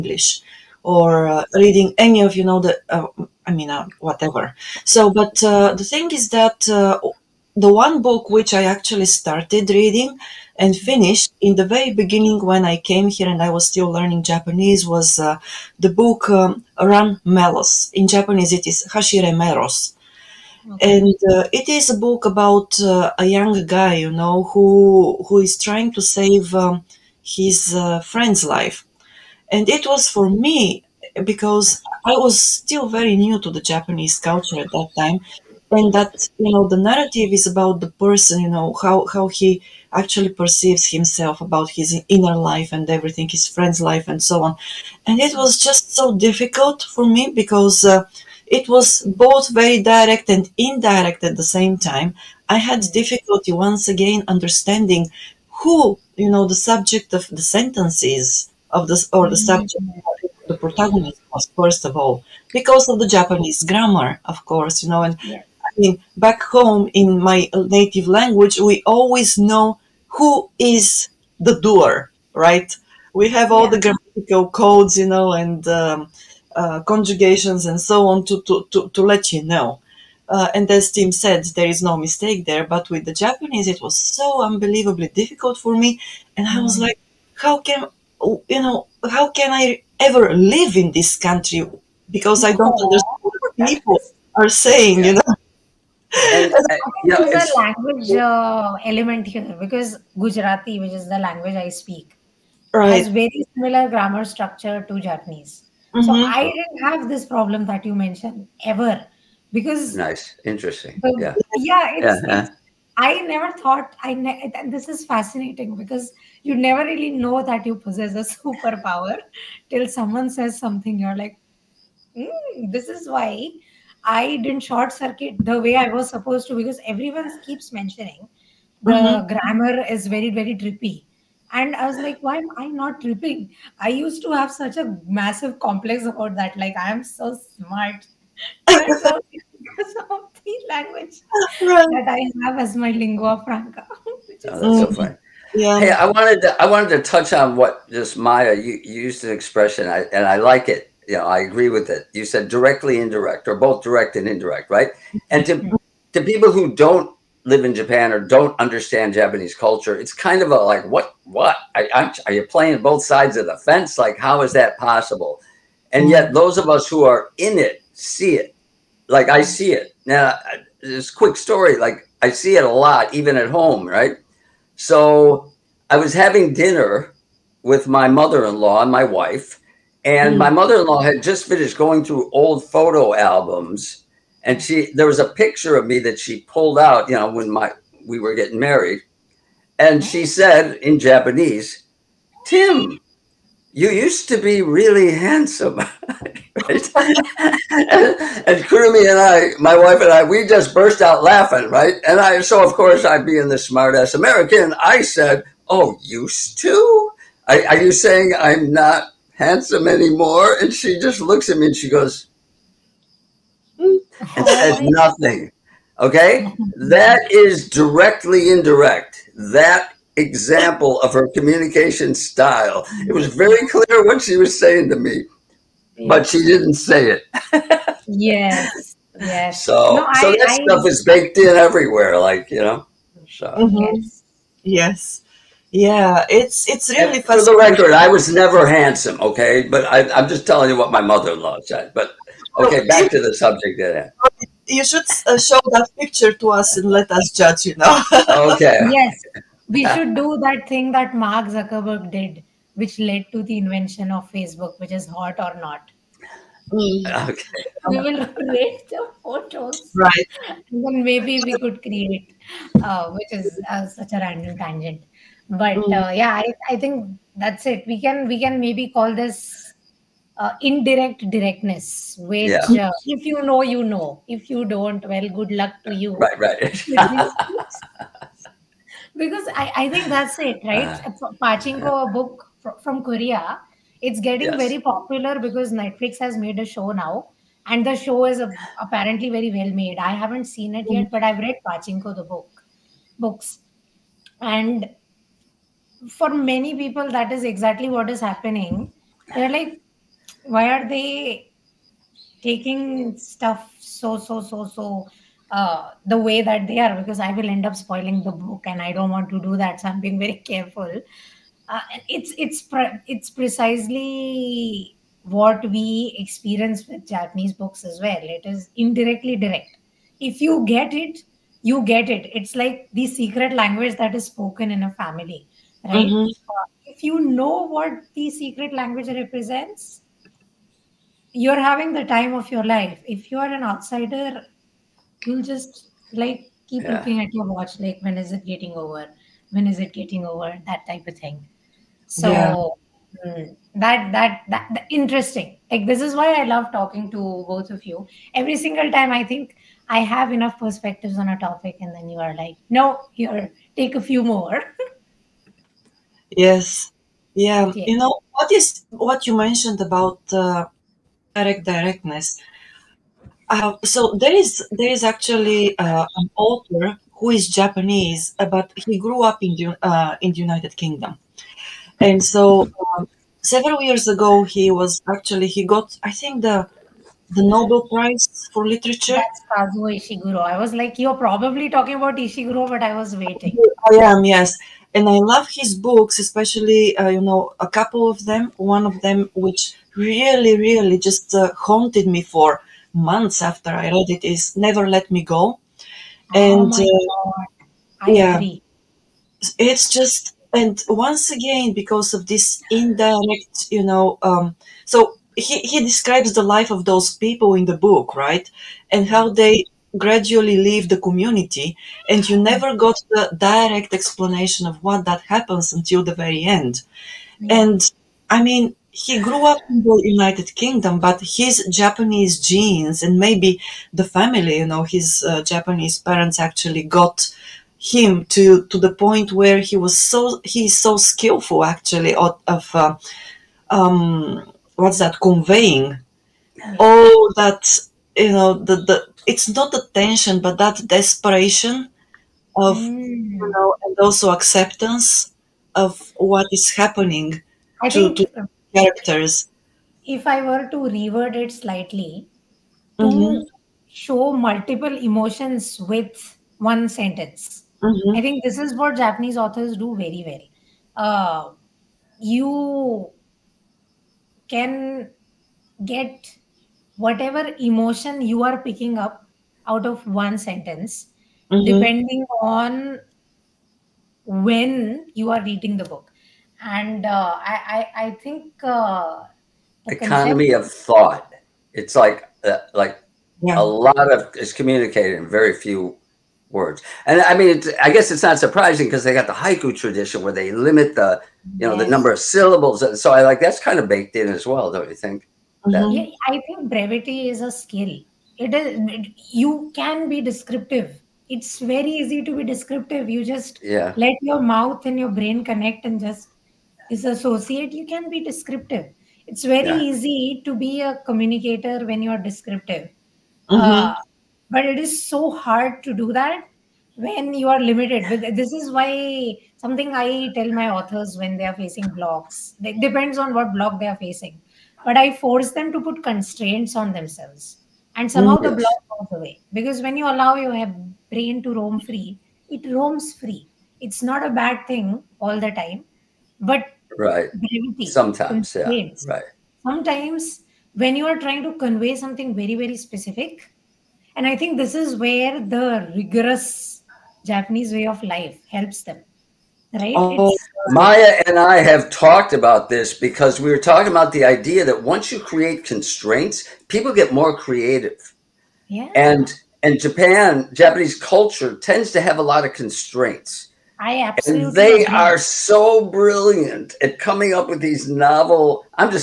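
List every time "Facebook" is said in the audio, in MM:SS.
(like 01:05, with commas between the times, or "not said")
04:14.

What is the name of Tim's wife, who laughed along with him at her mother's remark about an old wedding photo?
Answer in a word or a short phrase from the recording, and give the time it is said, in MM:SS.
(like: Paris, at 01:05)
Kurumi, at 03:18.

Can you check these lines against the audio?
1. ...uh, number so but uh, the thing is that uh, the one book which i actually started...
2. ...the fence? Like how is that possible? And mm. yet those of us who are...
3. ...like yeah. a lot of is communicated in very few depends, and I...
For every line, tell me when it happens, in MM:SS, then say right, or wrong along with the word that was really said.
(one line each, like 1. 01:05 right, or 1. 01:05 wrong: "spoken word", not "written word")
1. 00:03 wrong: "whatever", not "number"
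2. 02:43 right
3. 08:02 wrong: "words", not "depends".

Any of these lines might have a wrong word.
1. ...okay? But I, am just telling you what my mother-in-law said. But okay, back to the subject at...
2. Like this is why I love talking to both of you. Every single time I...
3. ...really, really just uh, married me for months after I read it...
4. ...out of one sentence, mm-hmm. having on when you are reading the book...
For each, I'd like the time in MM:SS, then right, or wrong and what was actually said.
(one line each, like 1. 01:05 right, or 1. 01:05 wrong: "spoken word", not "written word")
1. 03:59 right
2. 05:45 right
3. 06:29 wrong: "haunted", not "married"
4. 07:49 wrong: "depending", not "having".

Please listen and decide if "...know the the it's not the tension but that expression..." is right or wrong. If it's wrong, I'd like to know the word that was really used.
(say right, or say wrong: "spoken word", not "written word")
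wrong: "desperation", not "expression".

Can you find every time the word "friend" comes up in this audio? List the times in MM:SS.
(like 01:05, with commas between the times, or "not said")
00:28, 00:43.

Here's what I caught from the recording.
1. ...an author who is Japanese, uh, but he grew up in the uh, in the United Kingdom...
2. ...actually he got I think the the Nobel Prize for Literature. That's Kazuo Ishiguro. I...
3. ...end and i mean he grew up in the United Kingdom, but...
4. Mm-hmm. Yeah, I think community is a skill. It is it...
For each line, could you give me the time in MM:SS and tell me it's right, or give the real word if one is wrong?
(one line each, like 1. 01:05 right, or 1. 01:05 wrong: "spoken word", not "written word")
1. 06:06 right
2. 06:15 right
3. 06:56 right
4. 08:15 wrong: "brevity", not "community".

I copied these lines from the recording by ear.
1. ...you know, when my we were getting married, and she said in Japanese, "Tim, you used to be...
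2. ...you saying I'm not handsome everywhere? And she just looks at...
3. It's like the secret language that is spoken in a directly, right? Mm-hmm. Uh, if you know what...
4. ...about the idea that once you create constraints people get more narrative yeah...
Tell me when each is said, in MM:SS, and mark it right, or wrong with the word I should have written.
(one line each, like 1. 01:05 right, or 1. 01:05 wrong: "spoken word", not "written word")
1. 03:07 right
2. 03:27 wrong: "anymore", not "everywhere"
3. 05:22 wrong: "family", not "directly"
4. 09:13 wrong: "creative", not "narrative".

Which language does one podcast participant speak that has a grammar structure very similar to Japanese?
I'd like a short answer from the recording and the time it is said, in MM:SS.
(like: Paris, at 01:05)
Gujarati, at 01:40.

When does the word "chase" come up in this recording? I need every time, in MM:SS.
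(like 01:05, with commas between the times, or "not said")
not said.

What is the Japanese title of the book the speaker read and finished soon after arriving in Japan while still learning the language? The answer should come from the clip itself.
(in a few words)
Hashire Meros.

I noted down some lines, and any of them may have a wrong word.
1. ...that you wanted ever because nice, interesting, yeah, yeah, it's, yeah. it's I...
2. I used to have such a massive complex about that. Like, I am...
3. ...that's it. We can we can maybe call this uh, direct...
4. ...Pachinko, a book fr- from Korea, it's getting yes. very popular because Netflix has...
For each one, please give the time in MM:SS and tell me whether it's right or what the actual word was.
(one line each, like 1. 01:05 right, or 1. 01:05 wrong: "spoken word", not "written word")
1. 01:47 wrong: "mentioned", not "wanted"
2. 02:13 right
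3. 04:27 wrong: "indirect", not "direct"
4. 04:41 right.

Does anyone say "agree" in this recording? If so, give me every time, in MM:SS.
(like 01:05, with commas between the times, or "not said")
02:31, 06:38.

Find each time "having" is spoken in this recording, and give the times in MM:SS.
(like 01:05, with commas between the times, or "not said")
02:56, 05:31.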